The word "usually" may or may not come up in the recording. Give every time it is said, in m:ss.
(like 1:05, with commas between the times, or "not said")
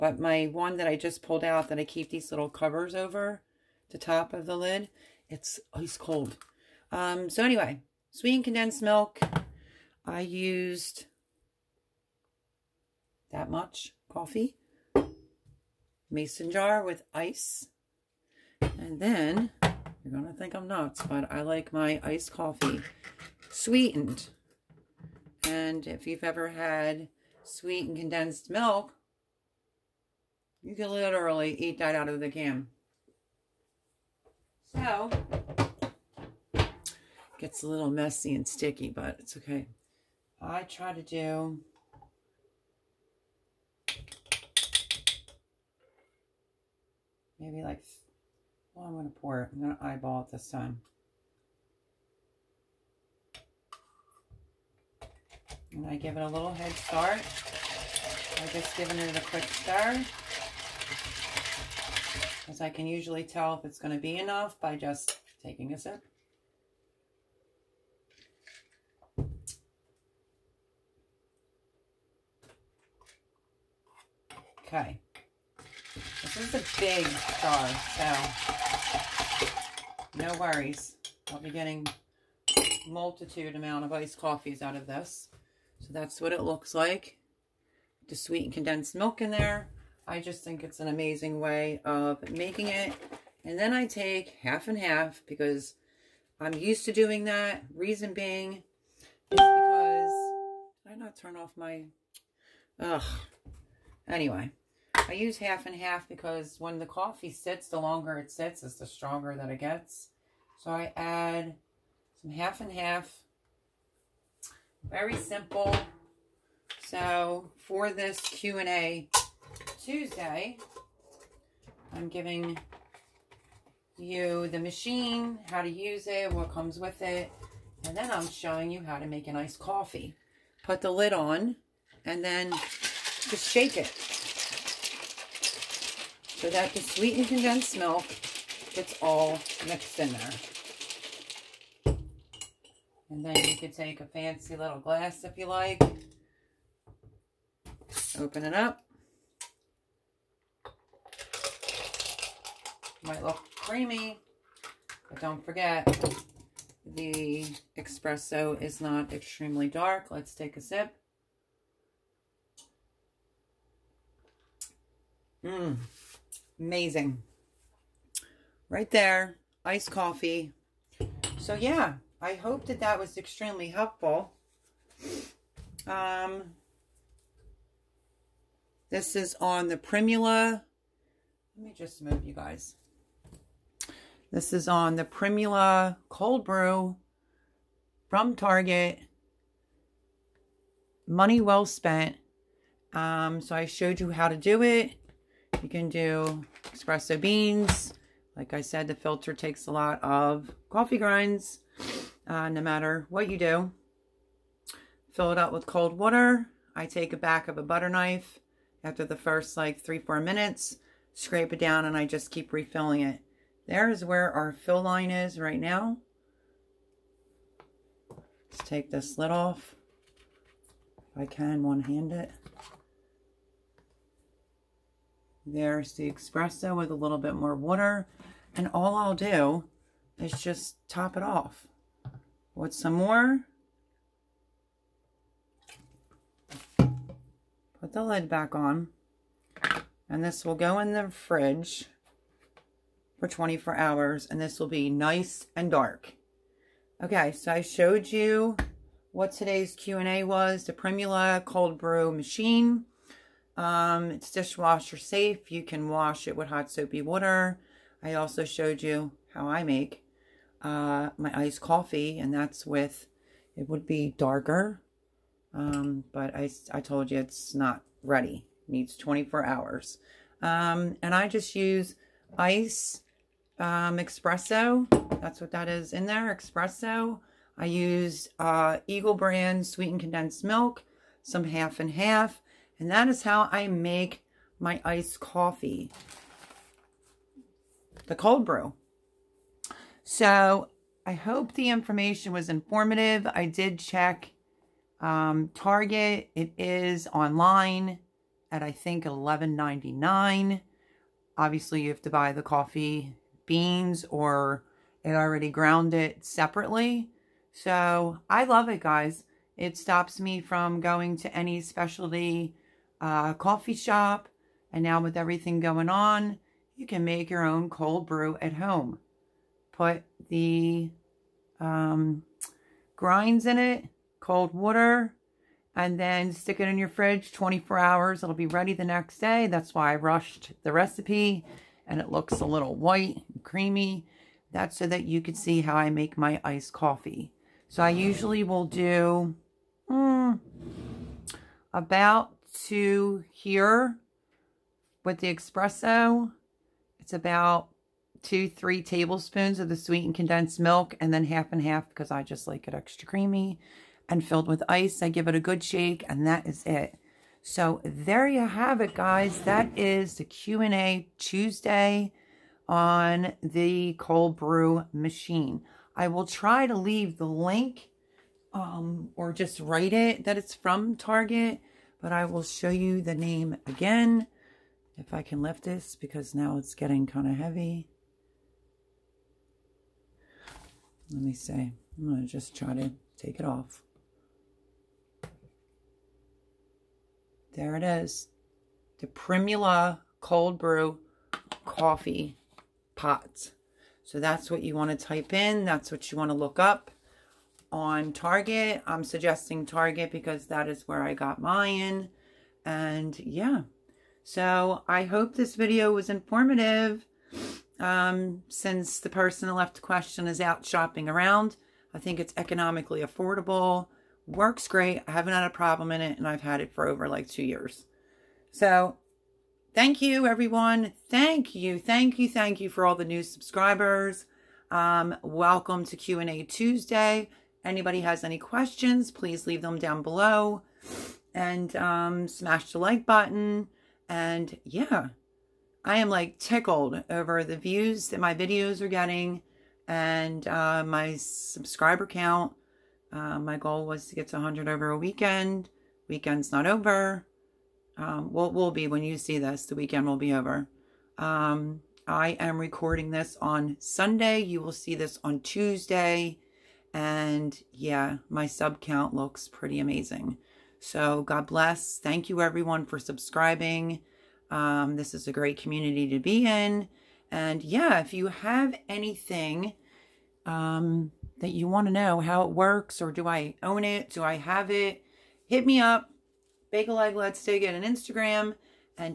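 1:02, 5:37.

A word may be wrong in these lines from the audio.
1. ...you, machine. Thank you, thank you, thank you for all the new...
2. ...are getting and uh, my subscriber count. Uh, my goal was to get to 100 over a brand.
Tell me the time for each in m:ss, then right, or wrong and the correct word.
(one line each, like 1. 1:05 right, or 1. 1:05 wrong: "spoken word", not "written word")
1. 7:00 wrong: "everyone", not "machine"
2. 7:18 wrong: "weekend", not "brand".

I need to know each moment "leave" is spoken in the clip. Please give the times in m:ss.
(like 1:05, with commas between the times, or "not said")
6:06, 7:09.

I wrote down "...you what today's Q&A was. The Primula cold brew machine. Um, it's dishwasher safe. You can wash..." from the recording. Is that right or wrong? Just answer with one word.
right.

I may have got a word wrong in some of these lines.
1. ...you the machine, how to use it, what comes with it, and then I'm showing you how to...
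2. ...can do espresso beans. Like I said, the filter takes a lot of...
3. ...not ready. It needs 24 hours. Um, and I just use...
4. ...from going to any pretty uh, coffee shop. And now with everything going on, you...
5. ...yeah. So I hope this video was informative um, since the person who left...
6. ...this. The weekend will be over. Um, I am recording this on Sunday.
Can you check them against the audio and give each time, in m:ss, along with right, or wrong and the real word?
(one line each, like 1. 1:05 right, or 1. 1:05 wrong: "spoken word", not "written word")
1. 2:03 right
2. 3:15 right
3. 4:27 right
4. 5:10 wrong: "specialty", not "pretty"
5. 6:43 right
6. 7:29 right.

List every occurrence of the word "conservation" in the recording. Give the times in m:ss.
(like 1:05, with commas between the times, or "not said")
not said.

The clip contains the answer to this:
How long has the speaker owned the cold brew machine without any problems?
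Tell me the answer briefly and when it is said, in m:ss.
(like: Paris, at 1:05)
Over 2 years, at 6:56.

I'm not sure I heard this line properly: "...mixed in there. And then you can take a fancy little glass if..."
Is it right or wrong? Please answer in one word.
right.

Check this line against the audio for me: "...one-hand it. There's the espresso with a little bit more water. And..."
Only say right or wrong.
right.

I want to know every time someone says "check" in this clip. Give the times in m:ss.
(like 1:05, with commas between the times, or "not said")
4:53.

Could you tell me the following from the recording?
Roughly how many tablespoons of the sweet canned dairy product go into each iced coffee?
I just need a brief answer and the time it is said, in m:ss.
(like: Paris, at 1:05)
2 to 3 tablespoons, at 5:48.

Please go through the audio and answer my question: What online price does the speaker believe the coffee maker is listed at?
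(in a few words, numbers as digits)
$11.99.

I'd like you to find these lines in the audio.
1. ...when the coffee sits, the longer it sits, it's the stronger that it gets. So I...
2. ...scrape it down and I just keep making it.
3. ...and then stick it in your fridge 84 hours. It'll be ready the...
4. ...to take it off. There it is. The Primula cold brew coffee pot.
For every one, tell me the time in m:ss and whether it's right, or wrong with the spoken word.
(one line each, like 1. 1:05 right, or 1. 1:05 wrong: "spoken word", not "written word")
1. 1:46 right
2. 3:31 wrong: "refilling", not "making"
3. 5:25 wrong: "24", not "84"
4. 6:22 right.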